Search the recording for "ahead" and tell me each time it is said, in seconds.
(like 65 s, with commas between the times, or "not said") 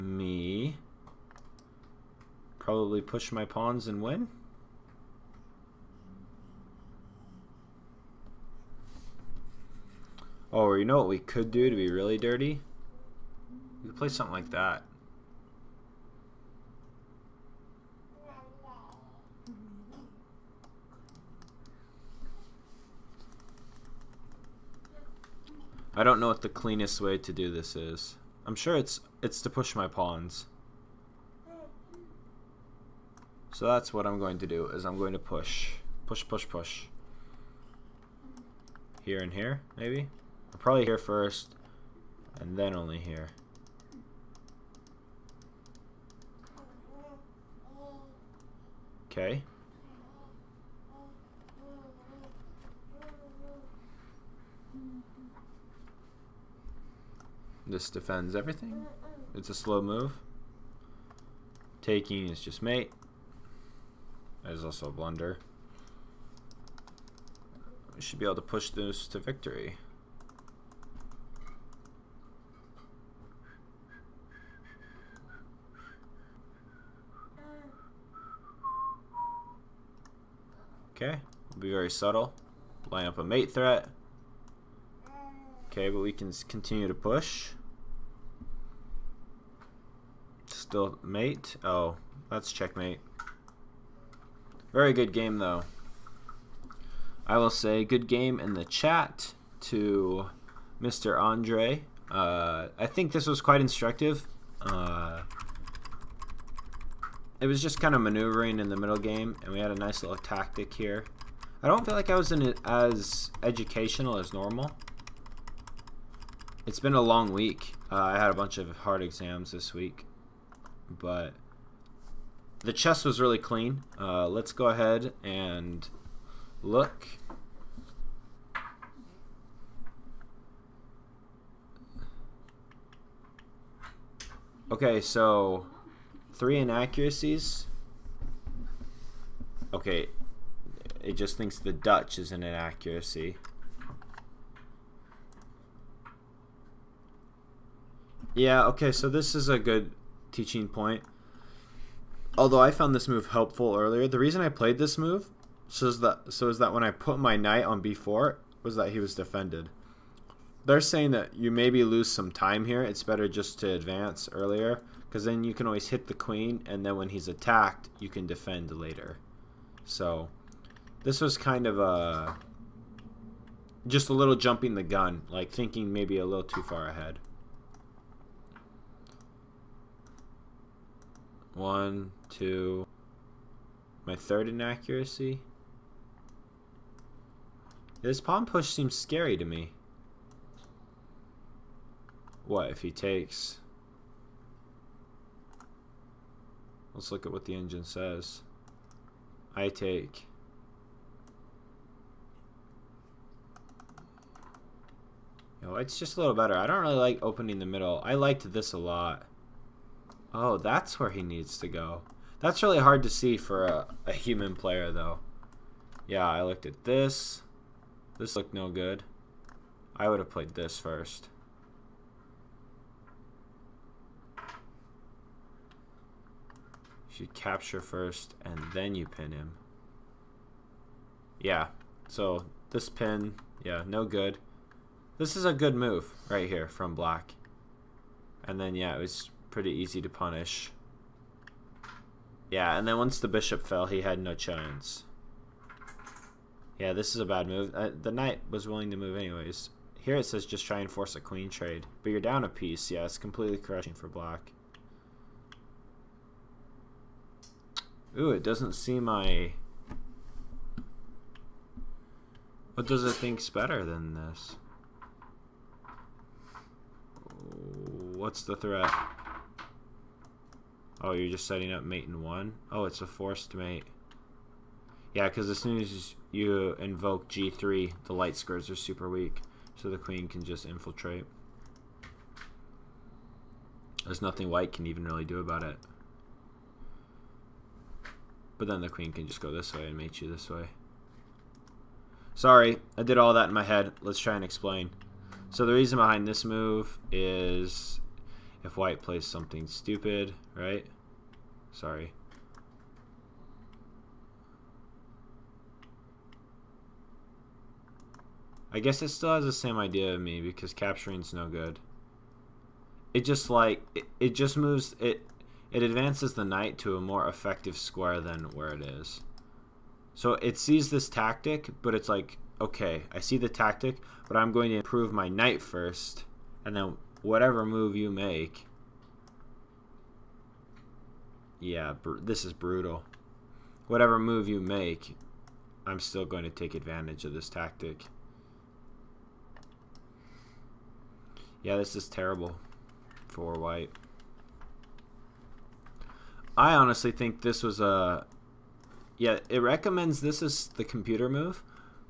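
124 s, 176 s.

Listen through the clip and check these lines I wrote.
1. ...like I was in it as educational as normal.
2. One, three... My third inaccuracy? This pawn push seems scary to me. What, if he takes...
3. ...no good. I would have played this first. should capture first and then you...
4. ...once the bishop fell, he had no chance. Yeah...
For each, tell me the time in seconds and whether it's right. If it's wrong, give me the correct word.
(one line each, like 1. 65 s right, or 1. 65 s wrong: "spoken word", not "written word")
1. 111 s right
2. 181 s wrong: "two", not "three"
3. 218 s right
4. 242 s right.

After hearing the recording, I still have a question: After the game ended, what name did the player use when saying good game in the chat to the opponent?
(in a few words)
Mr. Andre.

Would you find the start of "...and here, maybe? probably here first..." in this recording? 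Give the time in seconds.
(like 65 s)
39 s.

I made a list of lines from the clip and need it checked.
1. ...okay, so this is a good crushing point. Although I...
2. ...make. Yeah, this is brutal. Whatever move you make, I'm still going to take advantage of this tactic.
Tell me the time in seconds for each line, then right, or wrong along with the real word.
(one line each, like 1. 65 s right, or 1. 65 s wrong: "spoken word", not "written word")
1. 148 s wrong: "teaching", not "crushing"
2. 328 s right.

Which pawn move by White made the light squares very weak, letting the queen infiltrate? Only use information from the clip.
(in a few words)
g3.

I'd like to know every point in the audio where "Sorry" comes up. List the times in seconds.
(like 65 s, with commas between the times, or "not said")
292 s, 301 s.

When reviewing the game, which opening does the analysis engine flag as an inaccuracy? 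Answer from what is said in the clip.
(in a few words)
The Dutch.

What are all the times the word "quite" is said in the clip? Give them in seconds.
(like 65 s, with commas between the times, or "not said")
103 s.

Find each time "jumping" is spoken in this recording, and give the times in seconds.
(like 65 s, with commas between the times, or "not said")
174 s.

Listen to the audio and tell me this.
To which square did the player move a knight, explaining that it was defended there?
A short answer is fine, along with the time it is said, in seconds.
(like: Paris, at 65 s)
b4, at 157 s.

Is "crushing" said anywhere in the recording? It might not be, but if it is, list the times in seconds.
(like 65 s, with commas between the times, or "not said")
253 s.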